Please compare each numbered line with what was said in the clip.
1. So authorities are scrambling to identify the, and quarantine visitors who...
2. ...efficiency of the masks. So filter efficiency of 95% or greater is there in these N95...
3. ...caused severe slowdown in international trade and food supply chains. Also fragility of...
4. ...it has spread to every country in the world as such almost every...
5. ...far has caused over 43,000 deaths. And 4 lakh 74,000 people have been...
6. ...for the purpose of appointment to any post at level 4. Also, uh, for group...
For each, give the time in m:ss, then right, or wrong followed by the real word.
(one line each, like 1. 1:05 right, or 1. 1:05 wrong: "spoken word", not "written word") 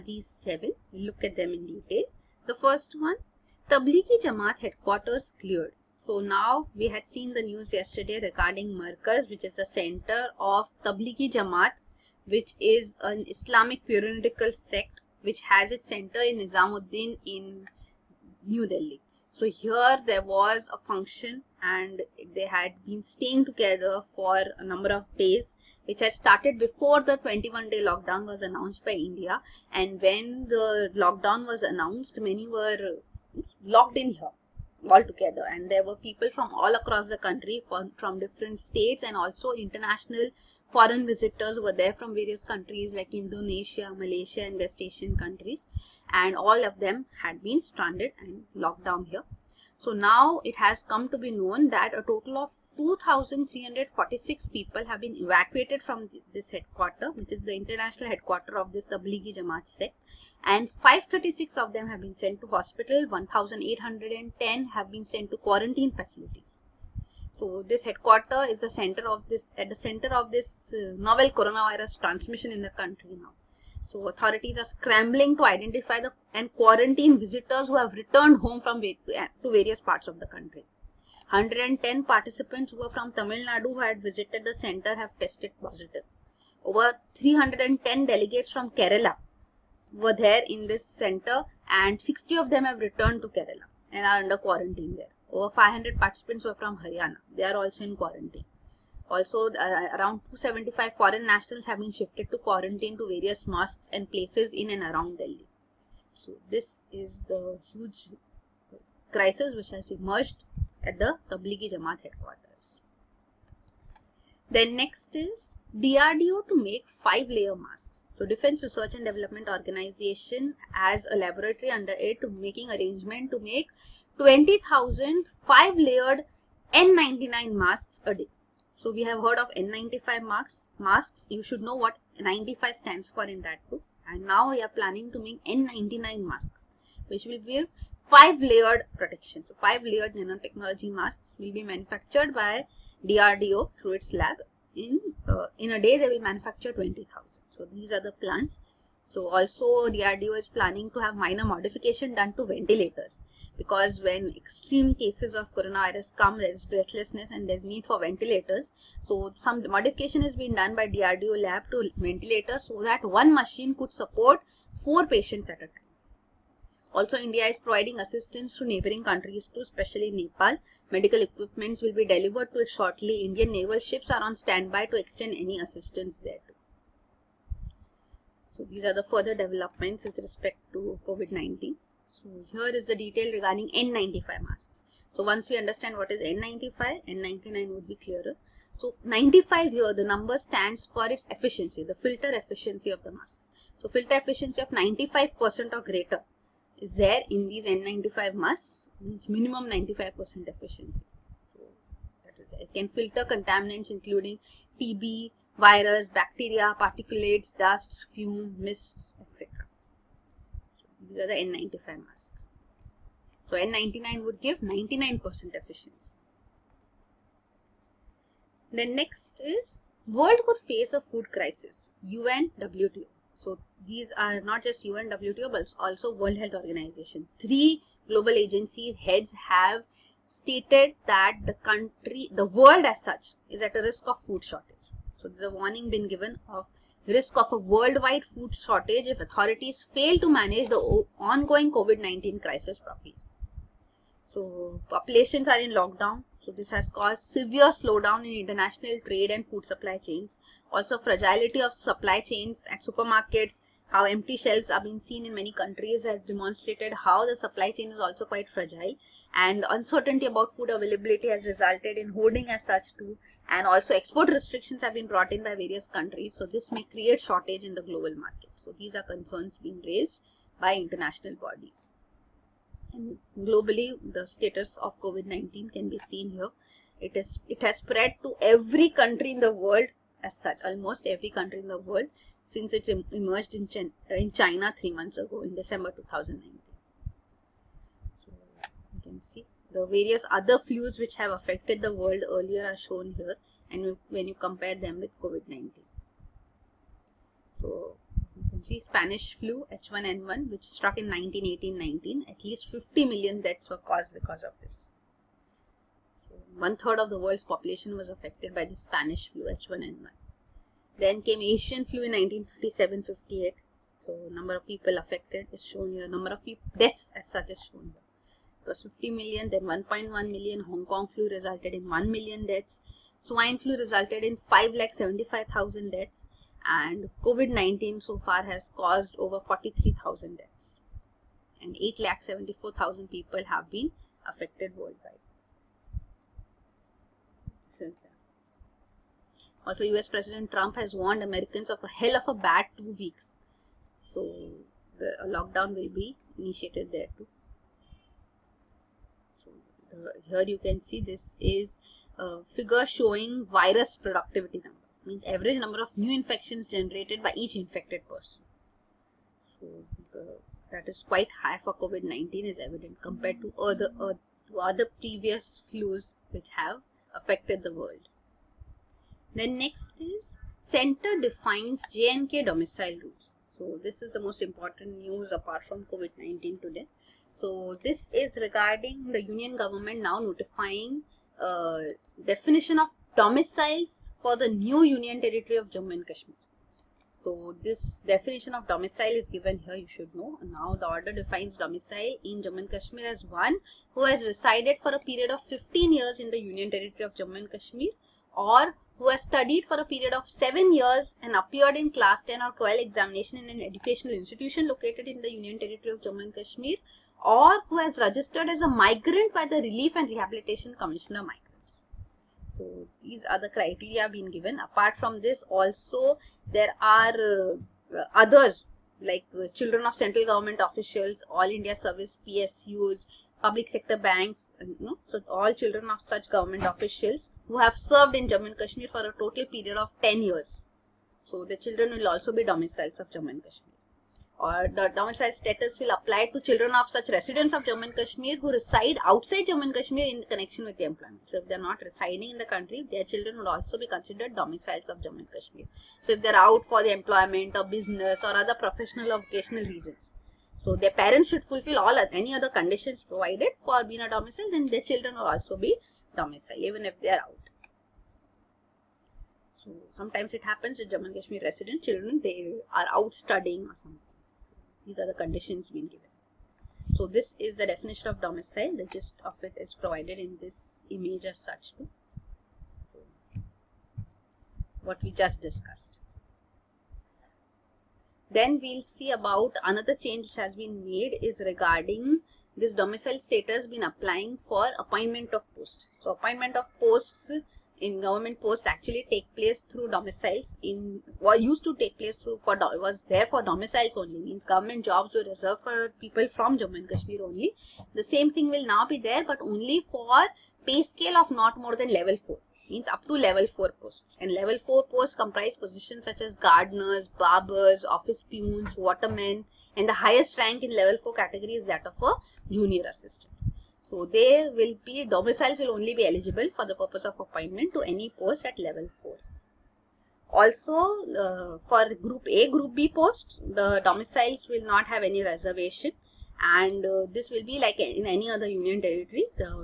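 1. 1:13 right
2. 3:12 right
3. 4:06 right
4. 4:37 right
5. 5:28 wrong: "8", not "4"
6. 8:36 right.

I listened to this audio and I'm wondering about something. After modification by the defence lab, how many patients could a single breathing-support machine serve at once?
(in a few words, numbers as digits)
four.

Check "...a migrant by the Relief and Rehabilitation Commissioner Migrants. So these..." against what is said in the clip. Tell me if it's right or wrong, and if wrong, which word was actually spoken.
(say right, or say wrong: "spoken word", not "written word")
right.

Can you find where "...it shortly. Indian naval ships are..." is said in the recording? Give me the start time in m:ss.
2:52.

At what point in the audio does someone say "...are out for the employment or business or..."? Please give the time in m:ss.
7:26.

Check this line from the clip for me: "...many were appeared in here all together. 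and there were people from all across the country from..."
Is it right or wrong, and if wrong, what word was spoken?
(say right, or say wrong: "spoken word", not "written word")
wrong: "locked", not "appeared".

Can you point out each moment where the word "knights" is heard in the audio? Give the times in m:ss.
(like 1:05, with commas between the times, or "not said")
not said.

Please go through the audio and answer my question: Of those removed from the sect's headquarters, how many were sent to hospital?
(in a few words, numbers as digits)
536.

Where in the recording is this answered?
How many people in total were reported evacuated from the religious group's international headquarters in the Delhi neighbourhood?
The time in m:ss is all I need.
0:52.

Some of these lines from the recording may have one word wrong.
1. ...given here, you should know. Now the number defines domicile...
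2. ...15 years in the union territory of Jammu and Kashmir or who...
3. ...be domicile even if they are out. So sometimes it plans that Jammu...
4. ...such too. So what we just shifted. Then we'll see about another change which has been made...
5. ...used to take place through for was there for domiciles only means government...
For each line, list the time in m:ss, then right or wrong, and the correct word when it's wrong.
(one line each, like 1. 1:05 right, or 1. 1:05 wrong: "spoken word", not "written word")
1. 6:29 wrong: "order", not "number"
2. 6:35 right
3. 7:35 wrong: "happens", not "plans"
4. 7:51 wrong: "discussed", not "shifted"
5. 8:11 right.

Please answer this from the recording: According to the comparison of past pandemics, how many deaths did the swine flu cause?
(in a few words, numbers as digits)
575,000.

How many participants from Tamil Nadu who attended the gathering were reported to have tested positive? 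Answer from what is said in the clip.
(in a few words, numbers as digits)
110.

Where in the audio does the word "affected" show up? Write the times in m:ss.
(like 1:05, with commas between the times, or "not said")
4:51, 5:08, 5:14, 5:34, 6:07.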